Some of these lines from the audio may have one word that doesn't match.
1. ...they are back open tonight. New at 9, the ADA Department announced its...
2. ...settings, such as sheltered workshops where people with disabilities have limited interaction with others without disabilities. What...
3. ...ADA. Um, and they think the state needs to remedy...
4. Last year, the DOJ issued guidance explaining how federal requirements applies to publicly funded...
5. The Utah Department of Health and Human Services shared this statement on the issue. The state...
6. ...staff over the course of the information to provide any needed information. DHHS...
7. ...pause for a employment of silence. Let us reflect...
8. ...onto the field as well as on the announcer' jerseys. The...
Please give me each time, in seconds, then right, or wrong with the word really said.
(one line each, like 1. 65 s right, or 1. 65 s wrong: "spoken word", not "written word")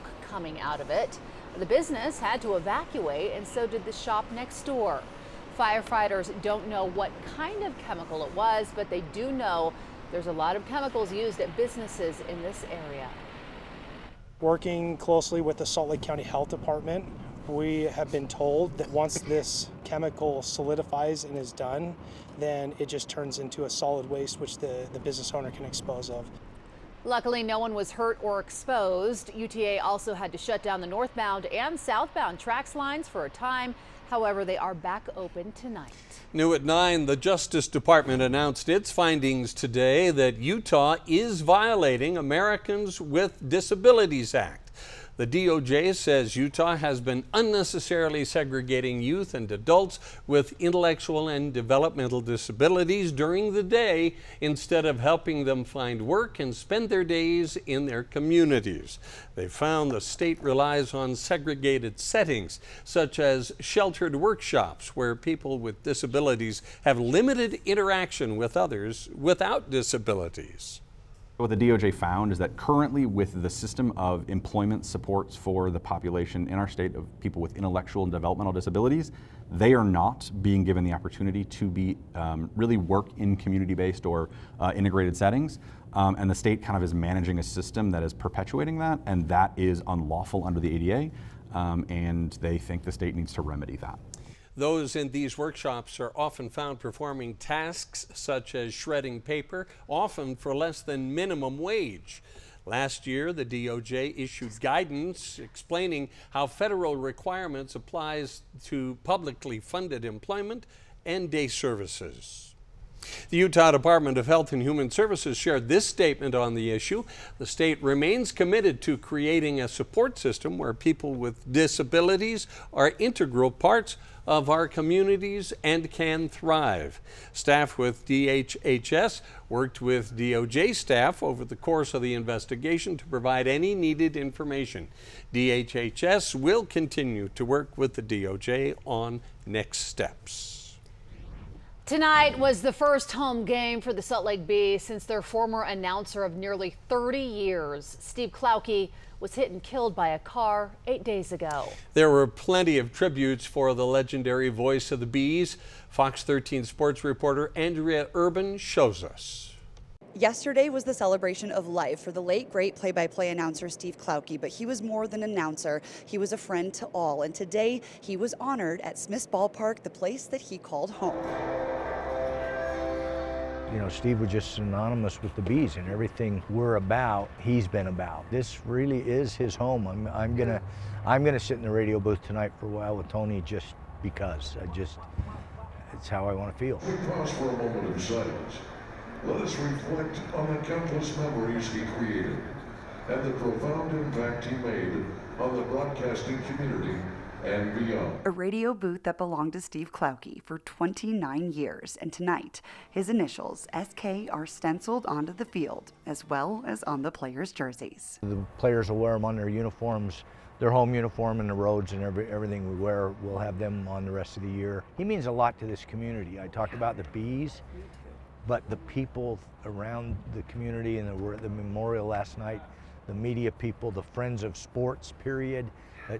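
1. 34 s wrong: "Justice", not "ADA"
2. 61 s right
3. 90 s right
4. 102 s right
5. 113 s right
6. 130 s wrong: "investigation", not "information"
7. 187 s wrong: "moment", not "employment"
8. 205 s wrong: "players", not "announcer".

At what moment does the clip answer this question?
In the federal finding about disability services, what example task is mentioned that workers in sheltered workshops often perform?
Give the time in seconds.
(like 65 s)
98 s.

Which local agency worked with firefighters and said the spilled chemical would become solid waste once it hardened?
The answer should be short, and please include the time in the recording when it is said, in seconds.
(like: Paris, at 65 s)
Salt Lake County Health Department, at 15 s.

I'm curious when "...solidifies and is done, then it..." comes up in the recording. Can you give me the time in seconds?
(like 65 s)
20 s.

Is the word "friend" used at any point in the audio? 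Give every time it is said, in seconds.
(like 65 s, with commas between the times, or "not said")
166 s, 224 s.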